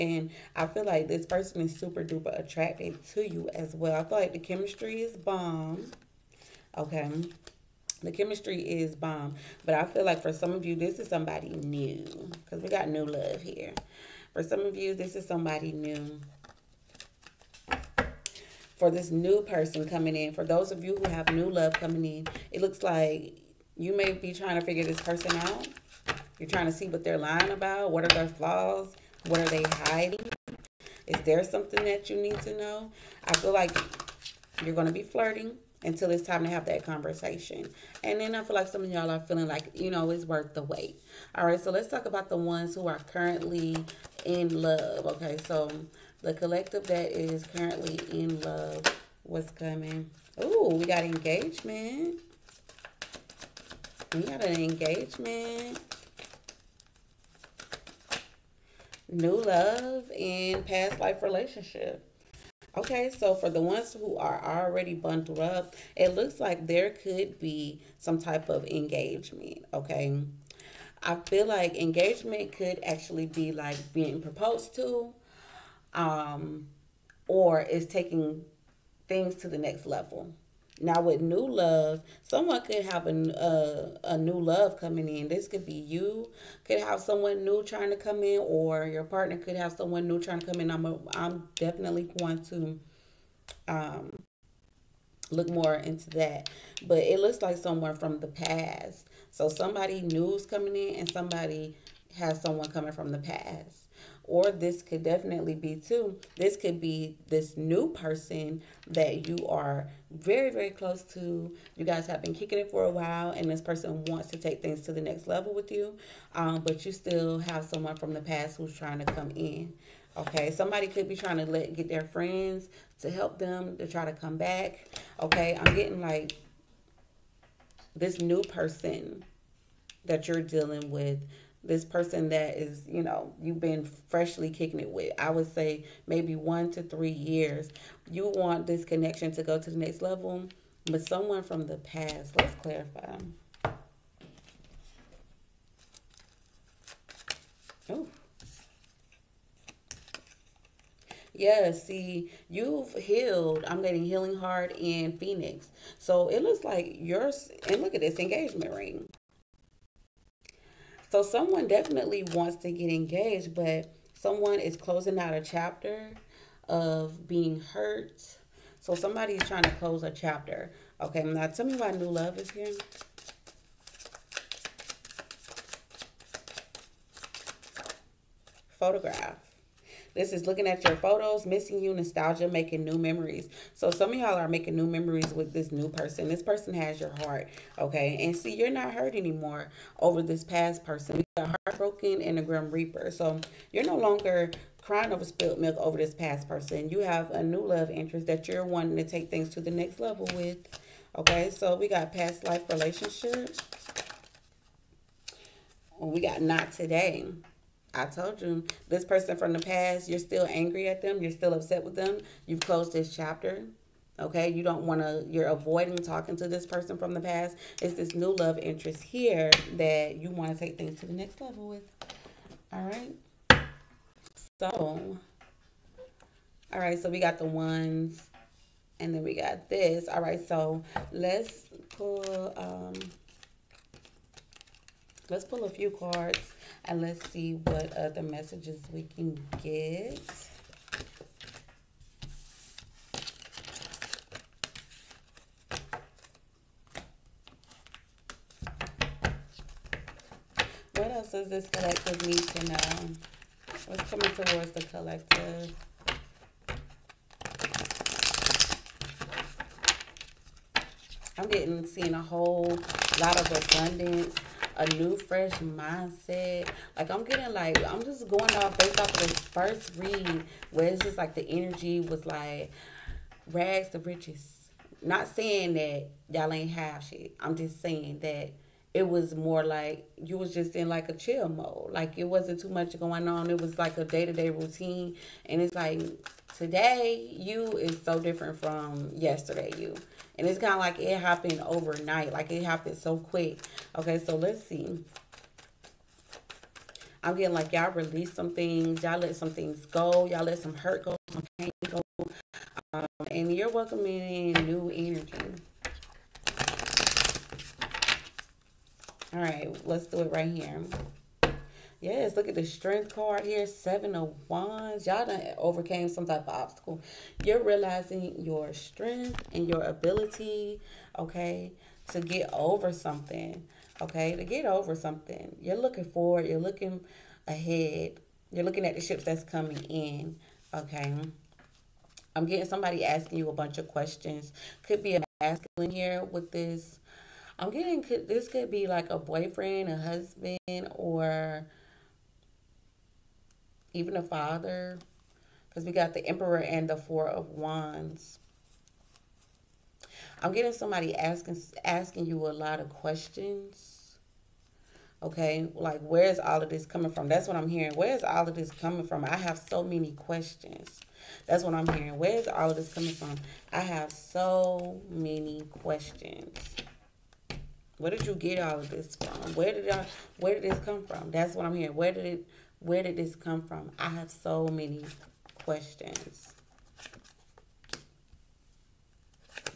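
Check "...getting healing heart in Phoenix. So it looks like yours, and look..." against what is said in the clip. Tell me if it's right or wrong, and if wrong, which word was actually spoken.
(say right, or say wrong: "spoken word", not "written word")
right.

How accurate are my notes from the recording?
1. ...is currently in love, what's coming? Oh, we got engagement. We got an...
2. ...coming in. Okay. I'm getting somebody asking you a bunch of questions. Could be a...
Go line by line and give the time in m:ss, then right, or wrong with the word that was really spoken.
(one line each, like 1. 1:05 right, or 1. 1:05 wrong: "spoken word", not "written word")
1. 0:47 right
2. 5:29 right.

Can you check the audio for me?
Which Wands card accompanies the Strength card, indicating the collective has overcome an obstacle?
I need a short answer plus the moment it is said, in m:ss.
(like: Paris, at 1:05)
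Seven of Wands, at 5:13.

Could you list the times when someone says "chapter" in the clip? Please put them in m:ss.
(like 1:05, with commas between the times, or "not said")
2:45, 2:50, 3:33.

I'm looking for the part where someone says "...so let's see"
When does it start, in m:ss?
4:54.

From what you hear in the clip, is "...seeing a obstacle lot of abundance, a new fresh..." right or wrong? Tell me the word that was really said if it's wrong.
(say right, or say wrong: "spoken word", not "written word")
wrong: "whole", not "obstacle".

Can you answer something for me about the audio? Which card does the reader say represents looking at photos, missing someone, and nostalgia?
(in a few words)
Photograph.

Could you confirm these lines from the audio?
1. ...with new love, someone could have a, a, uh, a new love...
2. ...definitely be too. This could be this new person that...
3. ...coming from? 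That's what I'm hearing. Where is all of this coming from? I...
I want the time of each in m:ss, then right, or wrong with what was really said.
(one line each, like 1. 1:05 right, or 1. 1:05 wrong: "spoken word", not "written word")
1. 1:21 right
2. 1:45 right
3. 5:56 right.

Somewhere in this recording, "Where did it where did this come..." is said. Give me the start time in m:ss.
6:11.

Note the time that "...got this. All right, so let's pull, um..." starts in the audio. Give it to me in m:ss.
3:49.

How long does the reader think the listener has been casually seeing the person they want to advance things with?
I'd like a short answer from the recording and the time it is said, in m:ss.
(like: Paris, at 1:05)
1 to 3 years, at 2:16.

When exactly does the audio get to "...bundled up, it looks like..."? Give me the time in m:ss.
1:04.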